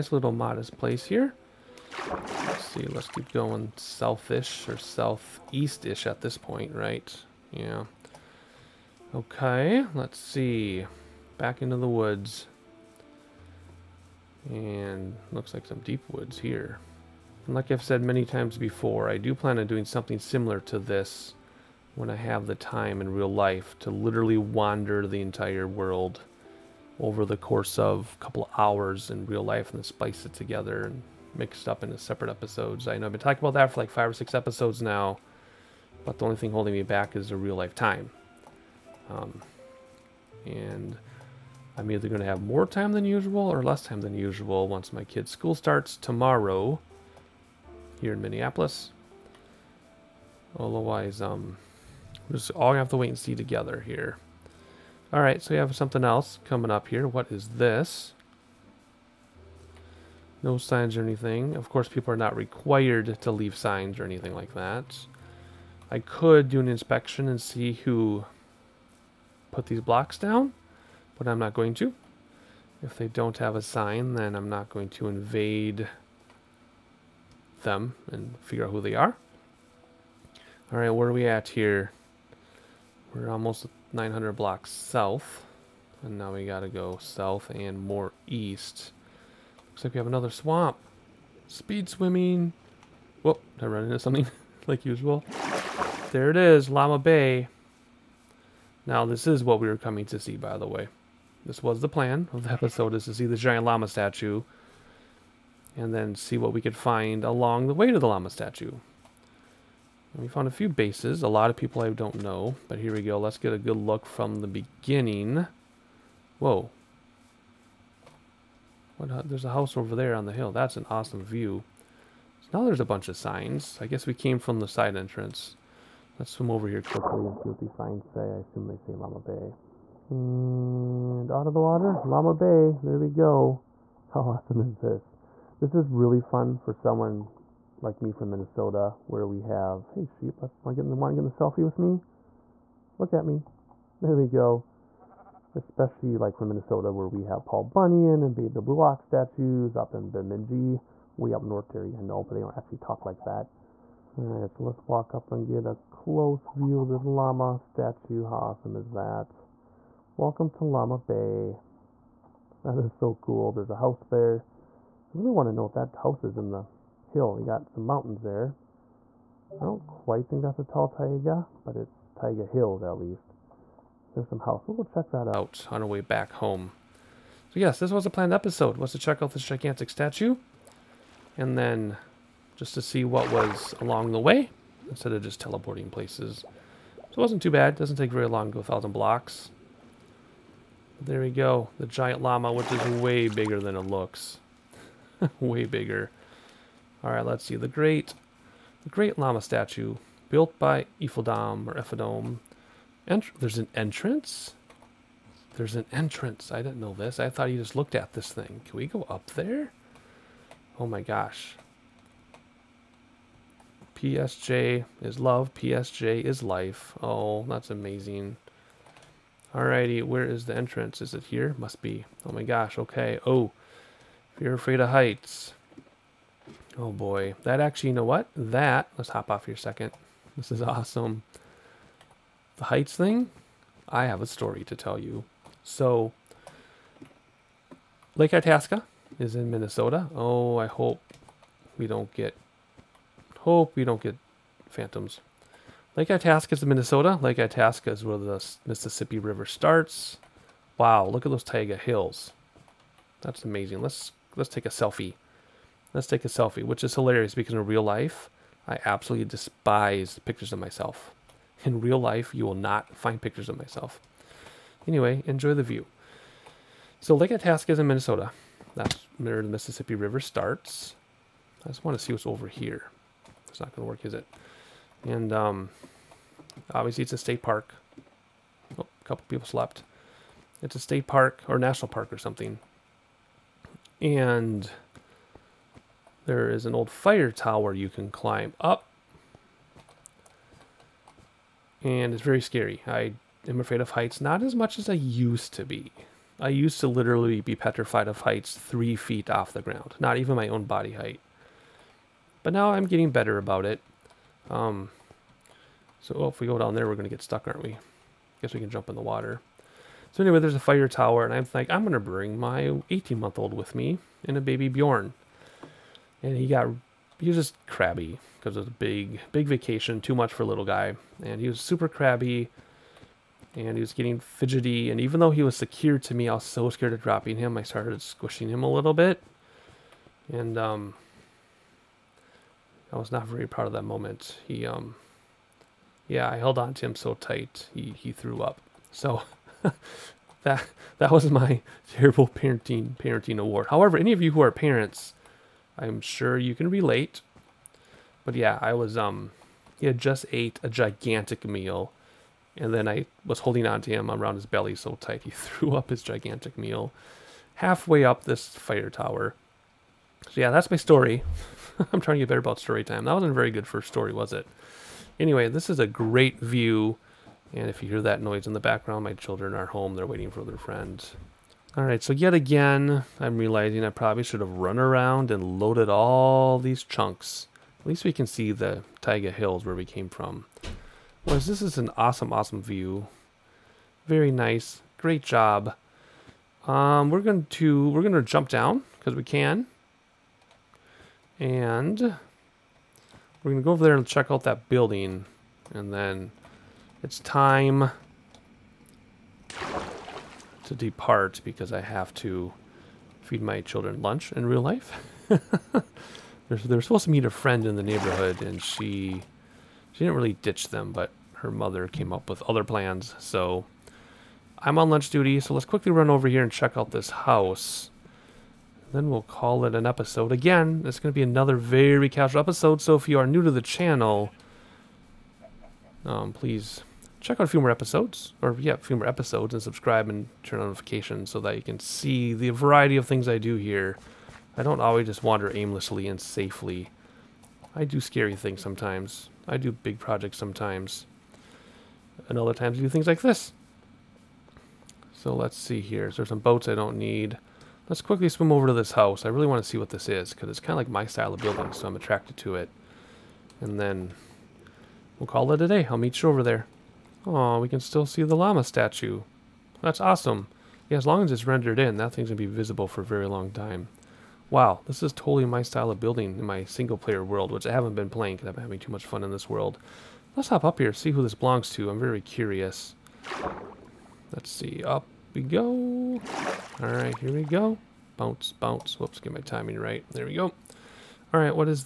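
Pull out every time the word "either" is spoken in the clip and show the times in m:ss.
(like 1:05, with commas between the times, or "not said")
0:41.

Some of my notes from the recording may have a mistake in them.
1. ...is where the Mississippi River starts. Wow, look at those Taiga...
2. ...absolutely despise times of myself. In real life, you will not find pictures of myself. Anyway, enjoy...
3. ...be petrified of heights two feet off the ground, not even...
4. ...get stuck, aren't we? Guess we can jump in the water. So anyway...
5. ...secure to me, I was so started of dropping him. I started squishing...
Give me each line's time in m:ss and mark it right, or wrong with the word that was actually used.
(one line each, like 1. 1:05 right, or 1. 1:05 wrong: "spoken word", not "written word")
1. 4:07 right
2. 4:18 wrong: "pictures", not "times"
3. 4:57 wrong: "three", not "two"
4. 5:07 right
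5. 5:25 wrong: "scared", not "started".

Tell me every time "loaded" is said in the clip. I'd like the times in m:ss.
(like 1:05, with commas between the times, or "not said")
6:15.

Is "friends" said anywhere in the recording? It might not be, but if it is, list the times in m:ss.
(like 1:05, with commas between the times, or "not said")
6:10, 6:47.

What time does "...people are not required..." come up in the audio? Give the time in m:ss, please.
1:01.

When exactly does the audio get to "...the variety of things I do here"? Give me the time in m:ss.
7:12.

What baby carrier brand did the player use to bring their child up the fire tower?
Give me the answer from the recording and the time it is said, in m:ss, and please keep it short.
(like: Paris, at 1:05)
BabyBjörn, at 5:14.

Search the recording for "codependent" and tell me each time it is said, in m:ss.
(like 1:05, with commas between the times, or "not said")
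not said.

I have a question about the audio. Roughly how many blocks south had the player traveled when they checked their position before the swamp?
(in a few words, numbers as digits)
900.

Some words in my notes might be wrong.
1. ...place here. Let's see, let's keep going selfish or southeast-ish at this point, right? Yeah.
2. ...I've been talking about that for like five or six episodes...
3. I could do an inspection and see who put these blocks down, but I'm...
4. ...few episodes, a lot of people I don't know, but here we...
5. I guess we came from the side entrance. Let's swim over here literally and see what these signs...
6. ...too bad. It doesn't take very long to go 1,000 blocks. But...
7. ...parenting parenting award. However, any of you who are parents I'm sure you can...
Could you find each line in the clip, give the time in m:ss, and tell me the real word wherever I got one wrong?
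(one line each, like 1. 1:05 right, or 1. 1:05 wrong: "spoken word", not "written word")
1. 0:00 right
2. 0:33 right
3. 1:05 right
4. 1:50 wrong: "bases", not "episodes"
5. 2:03 wrong: "quickly", not "literally"
6. 3:07 right
7. 5:42 right.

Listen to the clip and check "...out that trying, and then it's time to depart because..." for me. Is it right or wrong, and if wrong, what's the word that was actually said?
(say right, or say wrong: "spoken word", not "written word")
wrong: "building", not "trying".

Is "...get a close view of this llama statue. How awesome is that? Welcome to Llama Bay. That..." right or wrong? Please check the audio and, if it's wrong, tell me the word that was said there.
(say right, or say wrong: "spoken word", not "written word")
right.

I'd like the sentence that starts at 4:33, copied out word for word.
It's not going to work, is it?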